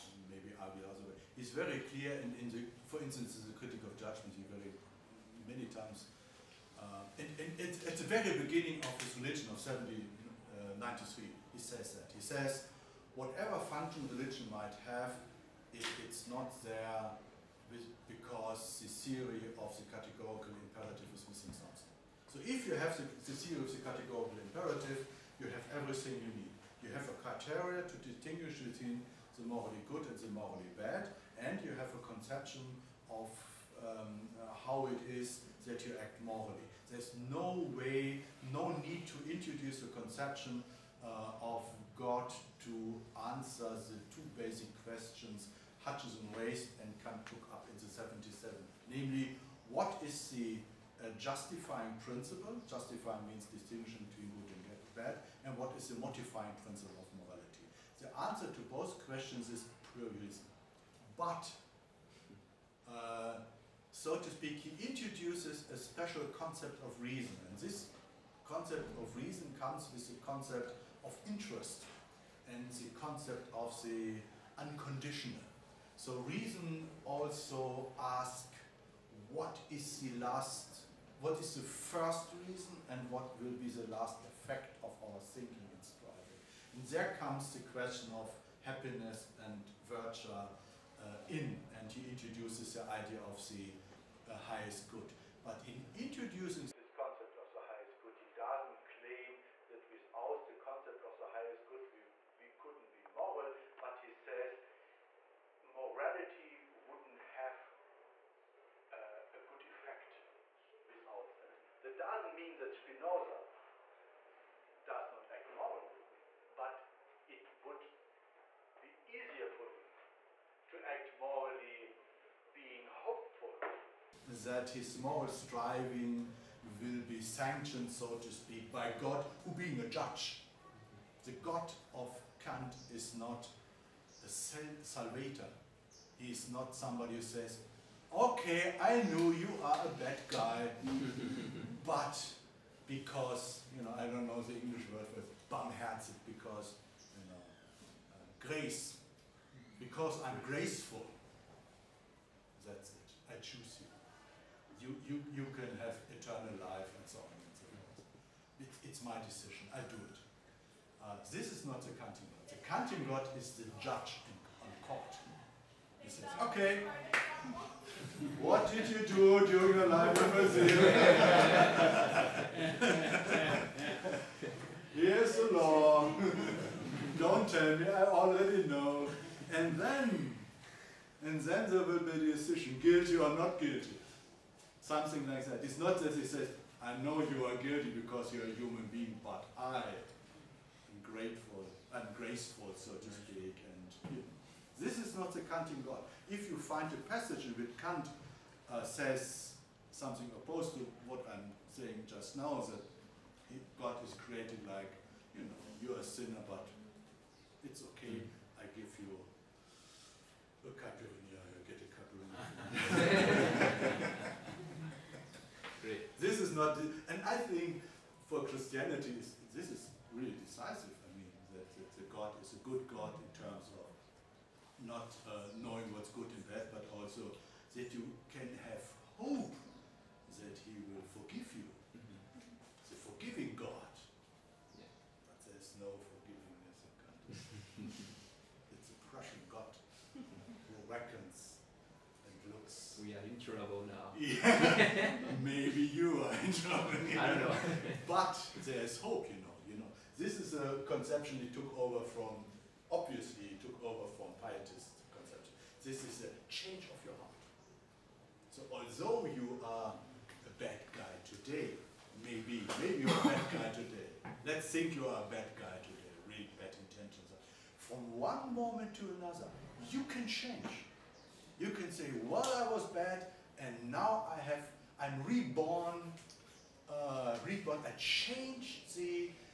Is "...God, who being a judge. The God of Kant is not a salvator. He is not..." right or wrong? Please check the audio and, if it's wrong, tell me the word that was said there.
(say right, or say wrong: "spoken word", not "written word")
right.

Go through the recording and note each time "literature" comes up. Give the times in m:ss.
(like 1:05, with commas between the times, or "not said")
not said.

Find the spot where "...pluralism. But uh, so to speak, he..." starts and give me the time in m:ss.
0:59.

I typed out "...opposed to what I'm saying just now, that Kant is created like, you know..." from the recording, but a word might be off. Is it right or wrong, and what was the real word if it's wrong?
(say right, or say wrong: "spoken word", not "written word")
wrong: "God", not "Kant".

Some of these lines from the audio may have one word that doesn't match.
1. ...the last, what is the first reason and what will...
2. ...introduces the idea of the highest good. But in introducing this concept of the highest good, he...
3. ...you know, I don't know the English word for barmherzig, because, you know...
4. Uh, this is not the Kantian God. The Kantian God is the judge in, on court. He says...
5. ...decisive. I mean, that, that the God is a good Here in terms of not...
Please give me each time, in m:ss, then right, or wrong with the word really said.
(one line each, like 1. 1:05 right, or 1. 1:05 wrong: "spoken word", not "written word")
1. 1:19 right
2. 1:32 right
3. 2:23 right
4. 2:41 right
5. 3:40 wrong: "God", not "Here".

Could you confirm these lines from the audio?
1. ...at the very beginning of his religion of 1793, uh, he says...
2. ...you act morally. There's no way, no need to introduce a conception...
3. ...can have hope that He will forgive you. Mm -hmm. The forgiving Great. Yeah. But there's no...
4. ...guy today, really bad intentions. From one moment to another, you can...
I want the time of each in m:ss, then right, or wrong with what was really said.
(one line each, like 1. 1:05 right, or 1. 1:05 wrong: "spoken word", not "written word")
1. 0:07 right
2. 0:35 right
3. 3:48 wrong: "God", not "Great"
4. 4:25 right.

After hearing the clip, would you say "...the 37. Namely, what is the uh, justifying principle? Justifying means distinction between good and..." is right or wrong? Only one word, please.
wrong.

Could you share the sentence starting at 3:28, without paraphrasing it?
I give you a caipirinha, you get a caipirinha.